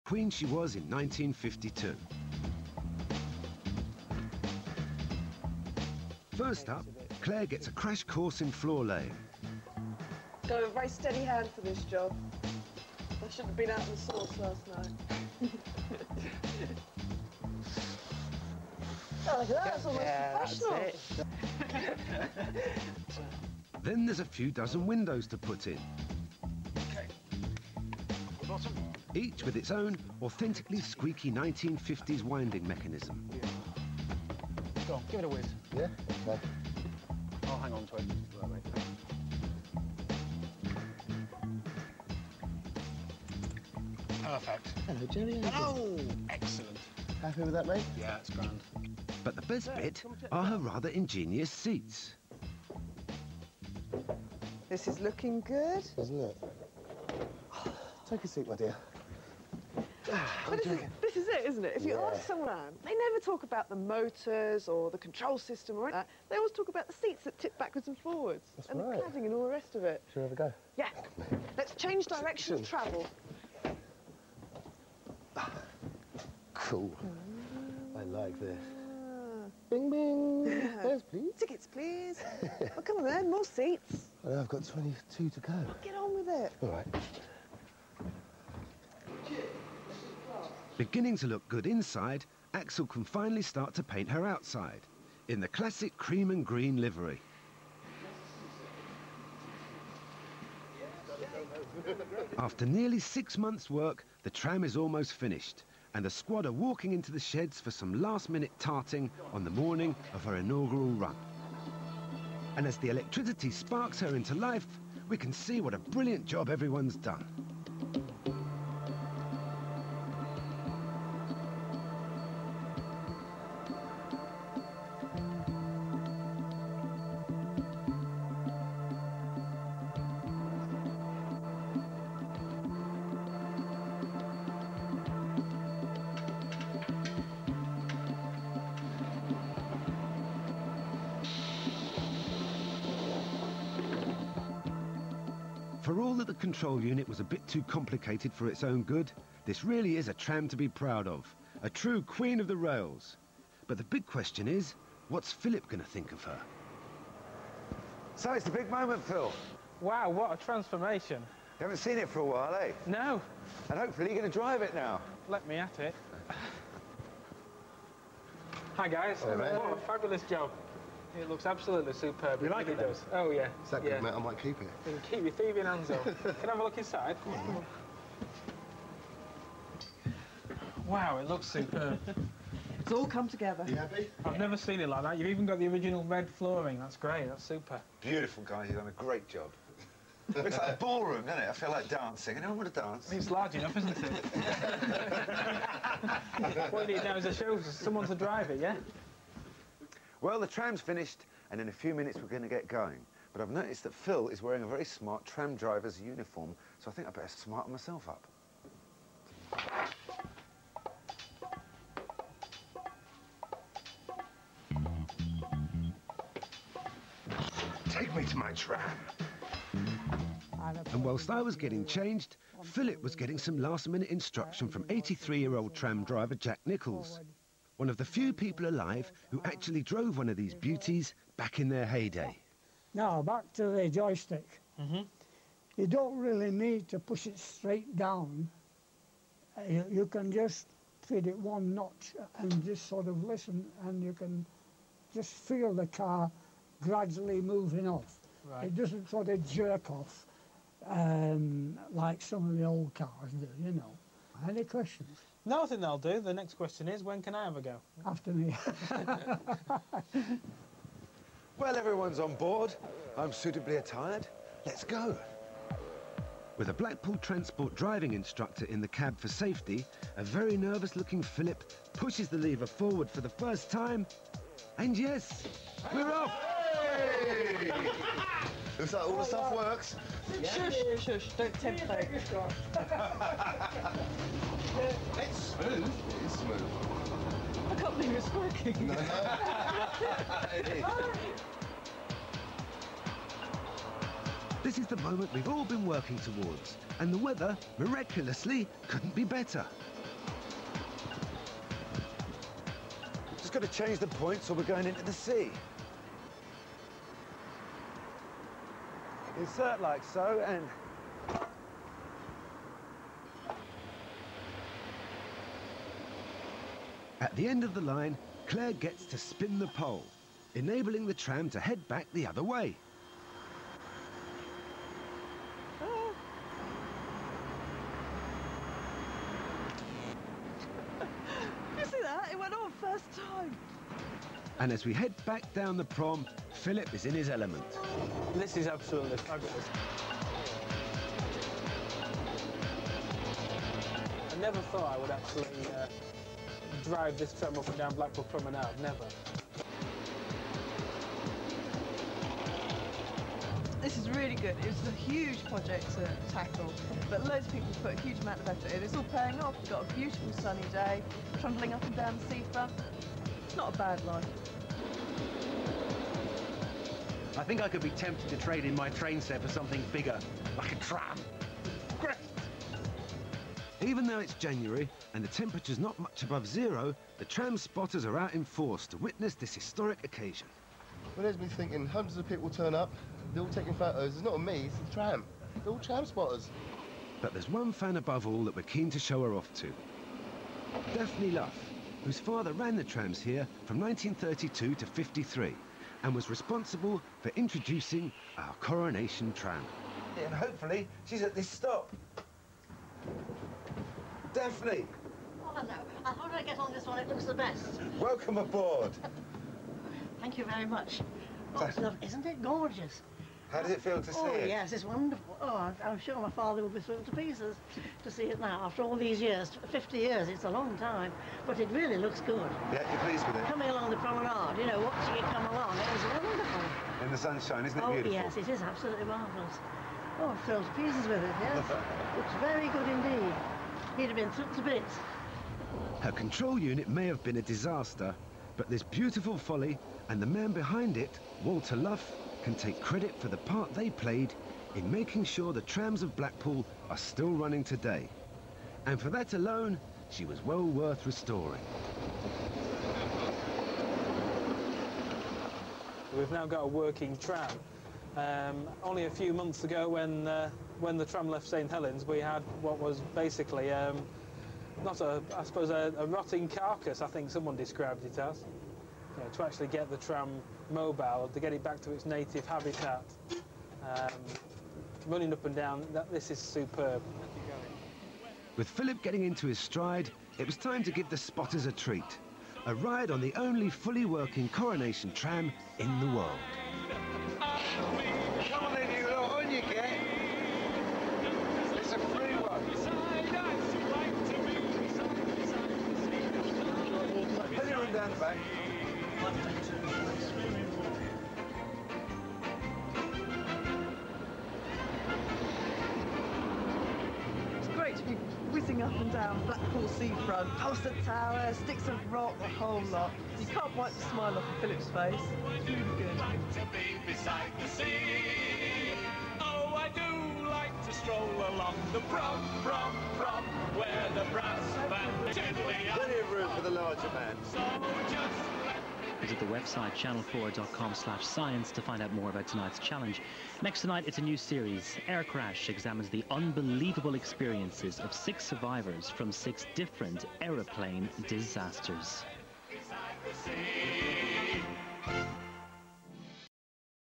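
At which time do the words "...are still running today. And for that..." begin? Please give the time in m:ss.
7:26.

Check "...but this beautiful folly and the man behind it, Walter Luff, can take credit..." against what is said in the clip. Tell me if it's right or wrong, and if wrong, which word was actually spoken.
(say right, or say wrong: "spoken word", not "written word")
right.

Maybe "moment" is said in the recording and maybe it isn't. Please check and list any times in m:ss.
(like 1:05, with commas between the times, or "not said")
2:38, 4:54.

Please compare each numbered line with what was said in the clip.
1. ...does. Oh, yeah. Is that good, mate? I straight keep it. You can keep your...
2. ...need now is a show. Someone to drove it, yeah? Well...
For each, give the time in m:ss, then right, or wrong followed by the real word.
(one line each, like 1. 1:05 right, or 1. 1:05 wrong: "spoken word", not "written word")
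1. 2:52 wrong: "might", not "straight"
2. 3:16 wrong: "drive", not "drove".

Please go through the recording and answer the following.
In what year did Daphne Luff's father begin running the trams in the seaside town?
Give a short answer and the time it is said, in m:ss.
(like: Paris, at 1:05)
1932, at 6:33.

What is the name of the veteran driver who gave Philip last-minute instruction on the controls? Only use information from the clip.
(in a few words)
Jack Nichols.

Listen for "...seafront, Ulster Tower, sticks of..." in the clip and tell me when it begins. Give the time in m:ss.
8:29.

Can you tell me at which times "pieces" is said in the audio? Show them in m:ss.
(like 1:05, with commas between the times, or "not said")
6:57, 7:10.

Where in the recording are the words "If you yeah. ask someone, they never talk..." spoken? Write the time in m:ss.
1:01.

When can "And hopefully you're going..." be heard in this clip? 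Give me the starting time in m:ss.
2:43.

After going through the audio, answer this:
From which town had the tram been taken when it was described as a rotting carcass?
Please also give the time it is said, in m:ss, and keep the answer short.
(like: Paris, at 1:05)
St Helens, at 7:41.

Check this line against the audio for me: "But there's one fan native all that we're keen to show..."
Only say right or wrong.
wrong.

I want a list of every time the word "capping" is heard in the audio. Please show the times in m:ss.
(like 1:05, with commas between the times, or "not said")
not said.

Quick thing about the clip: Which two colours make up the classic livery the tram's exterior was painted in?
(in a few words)
cream and green.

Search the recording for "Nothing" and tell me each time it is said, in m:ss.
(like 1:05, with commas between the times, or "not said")
4:15.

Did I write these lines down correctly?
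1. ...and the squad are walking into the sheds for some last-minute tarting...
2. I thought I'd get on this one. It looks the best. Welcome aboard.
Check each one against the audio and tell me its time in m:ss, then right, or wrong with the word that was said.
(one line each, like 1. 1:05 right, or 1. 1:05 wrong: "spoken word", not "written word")
1. 1:45 right
2. 6:46 right.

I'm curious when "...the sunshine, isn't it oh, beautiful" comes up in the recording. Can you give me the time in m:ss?
7:07.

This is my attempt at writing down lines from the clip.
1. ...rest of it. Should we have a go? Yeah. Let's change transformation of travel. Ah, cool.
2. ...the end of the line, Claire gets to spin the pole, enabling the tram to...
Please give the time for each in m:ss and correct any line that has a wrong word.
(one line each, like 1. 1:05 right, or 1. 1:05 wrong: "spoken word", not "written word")
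1. 1:09 wrong: "direction", not "transformation"
2. 5:17 right.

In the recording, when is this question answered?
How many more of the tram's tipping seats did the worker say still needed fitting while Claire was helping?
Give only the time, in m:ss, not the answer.
1:24.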